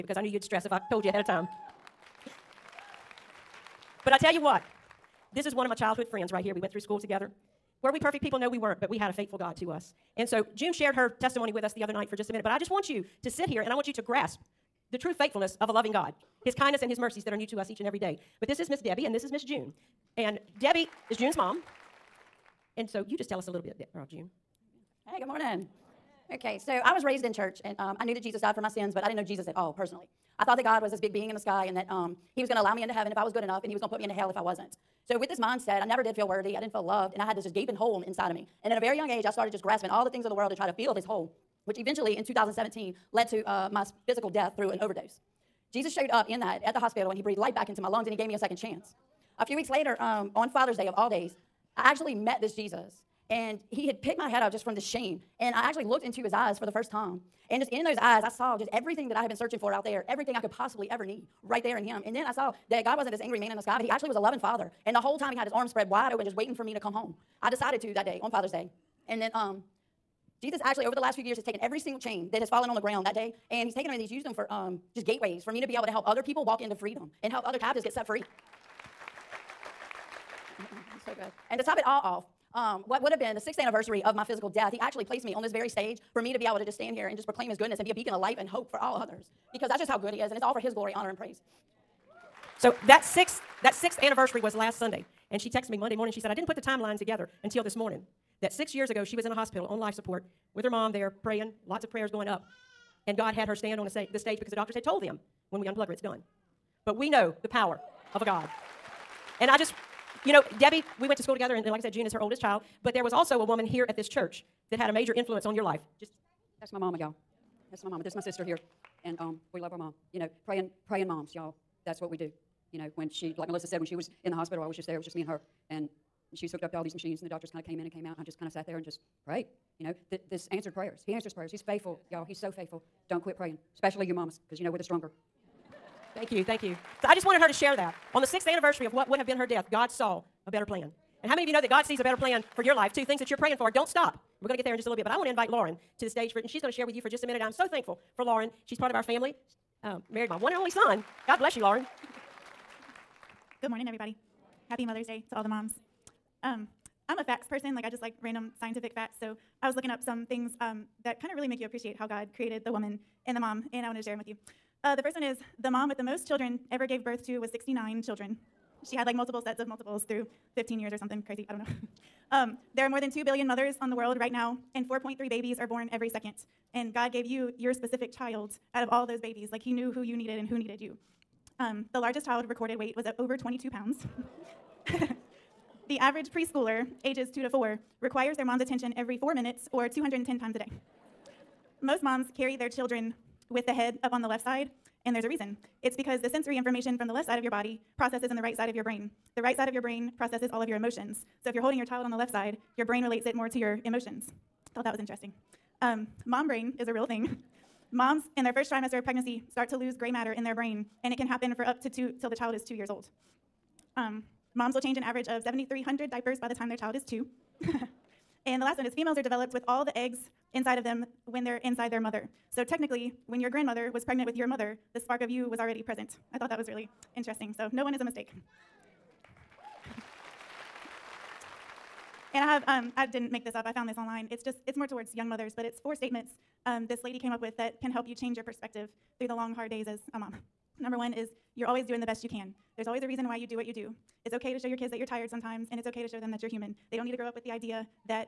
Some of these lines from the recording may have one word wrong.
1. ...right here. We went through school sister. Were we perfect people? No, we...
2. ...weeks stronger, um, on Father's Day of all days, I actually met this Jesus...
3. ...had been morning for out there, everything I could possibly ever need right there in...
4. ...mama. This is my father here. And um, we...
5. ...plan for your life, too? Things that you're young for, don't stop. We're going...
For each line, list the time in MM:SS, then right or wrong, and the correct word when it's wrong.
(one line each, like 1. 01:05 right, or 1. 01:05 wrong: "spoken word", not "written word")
1. 00:06 wrong: "together", not "sister"
2. 00:49 wrong: "later", not "stronger"
3. 00:59 wrong: "searching", not "morning"
4. 01:57 wrong: "sister", not "father"
5. 02:22 wrong: "praying", not "young".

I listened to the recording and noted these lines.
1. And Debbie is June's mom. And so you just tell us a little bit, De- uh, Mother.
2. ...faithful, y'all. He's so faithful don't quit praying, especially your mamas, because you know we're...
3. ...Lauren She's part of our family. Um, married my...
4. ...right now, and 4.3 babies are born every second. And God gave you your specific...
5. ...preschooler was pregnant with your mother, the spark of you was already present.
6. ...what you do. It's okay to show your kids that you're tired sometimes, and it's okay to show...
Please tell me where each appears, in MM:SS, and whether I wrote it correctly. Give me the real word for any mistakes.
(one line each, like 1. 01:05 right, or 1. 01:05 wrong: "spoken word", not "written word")
1. 00:20 wrong: "June", not "Mother"
2. 02:11 right
3. 02:28 right
4. 02:54 right
5. 03:43 wrong: "grandmother", not "preschooler"
6. 04:03 right.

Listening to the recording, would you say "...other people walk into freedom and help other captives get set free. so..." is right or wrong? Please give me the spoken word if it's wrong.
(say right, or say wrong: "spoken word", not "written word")
right.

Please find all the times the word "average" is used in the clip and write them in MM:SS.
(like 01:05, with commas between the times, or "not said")
03:05, 03:35.